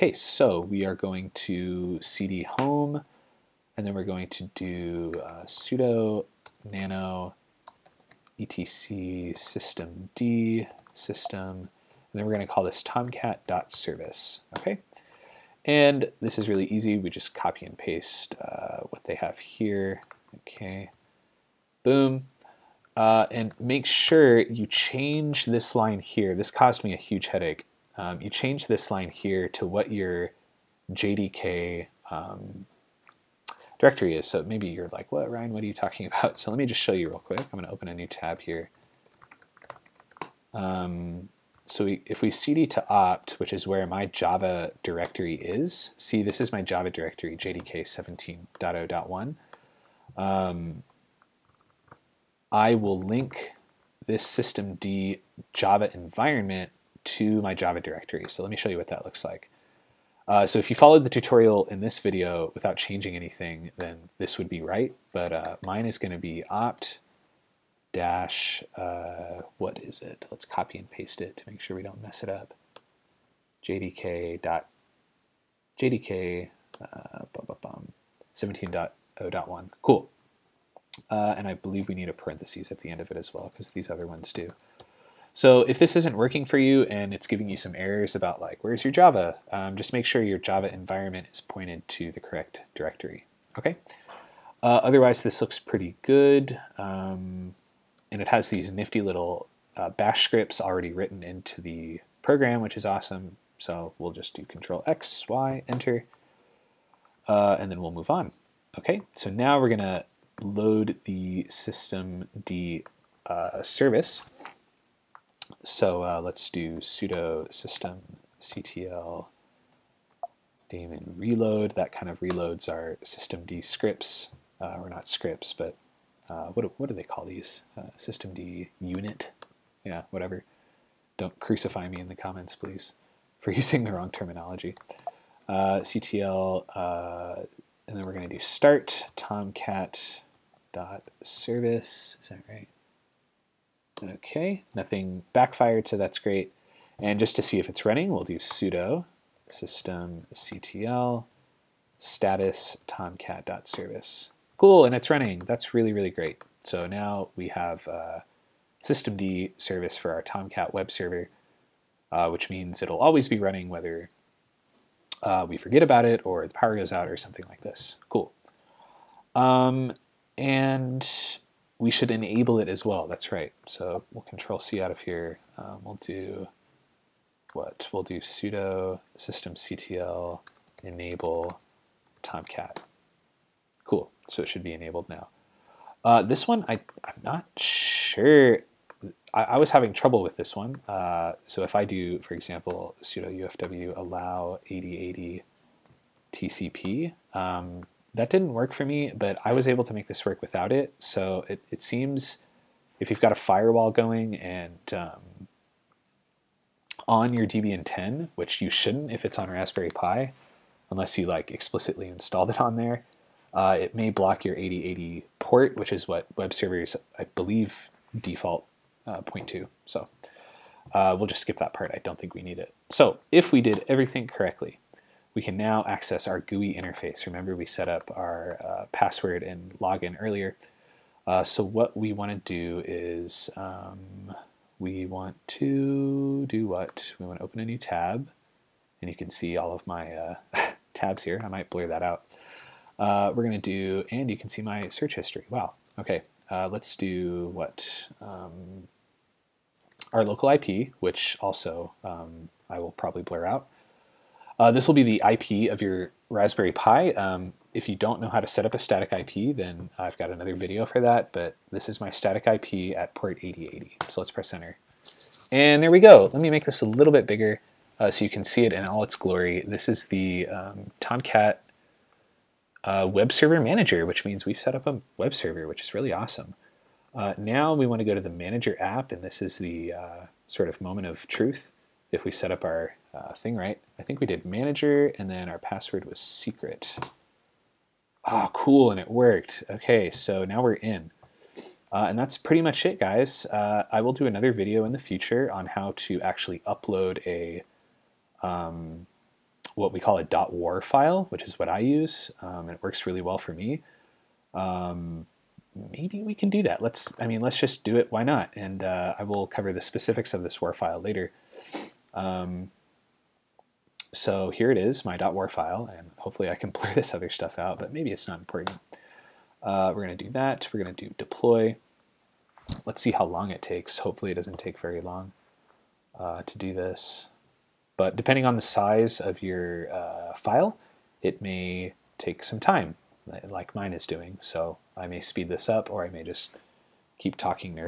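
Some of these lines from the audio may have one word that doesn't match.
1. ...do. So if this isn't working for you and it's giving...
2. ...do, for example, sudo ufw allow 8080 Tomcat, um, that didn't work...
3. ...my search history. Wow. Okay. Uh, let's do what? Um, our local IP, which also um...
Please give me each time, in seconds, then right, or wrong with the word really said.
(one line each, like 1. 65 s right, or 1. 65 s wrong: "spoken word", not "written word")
1. 84 s right
2. 191 s wrong: "TCP", not "Tomcat"
3. 244 s right.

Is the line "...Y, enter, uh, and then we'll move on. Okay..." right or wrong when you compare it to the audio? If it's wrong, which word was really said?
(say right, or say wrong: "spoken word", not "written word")
right.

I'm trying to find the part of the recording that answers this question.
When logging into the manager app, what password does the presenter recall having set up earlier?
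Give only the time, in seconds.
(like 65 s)
286 s.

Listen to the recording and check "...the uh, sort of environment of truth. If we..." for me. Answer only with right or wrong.
wrong.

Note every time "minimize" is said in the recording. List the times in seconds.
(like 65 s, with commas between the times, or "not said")
not said.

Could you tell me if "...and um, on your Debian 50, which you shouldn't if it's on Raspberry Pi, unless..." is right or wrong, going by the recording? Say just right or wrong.
wrong.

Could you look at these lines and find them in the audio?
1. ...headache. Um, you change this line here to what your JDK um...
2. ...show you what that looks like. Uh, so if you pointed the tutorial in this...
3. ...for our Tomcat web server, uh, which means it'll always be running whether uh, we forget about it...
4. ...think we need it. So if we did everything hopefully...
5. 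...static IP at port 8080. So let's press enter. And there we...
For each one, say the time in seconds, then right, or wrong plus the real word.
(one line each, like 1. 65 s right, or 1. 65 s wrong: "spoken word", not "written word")
1. 27 s right
2. 58 s wrong: "followed", not "pointed"
3. 159 s right
4. 222 s wrong: "correctly", not "hopefully"
5. 262 s right.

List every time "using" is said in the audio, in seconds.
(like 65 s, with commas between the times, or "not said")
133 s.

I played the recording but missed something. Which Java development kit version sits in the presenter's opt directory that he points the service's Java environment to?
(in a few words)
17.0.1.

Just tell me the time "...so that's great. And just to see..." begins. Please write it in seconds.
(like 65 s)
145 s.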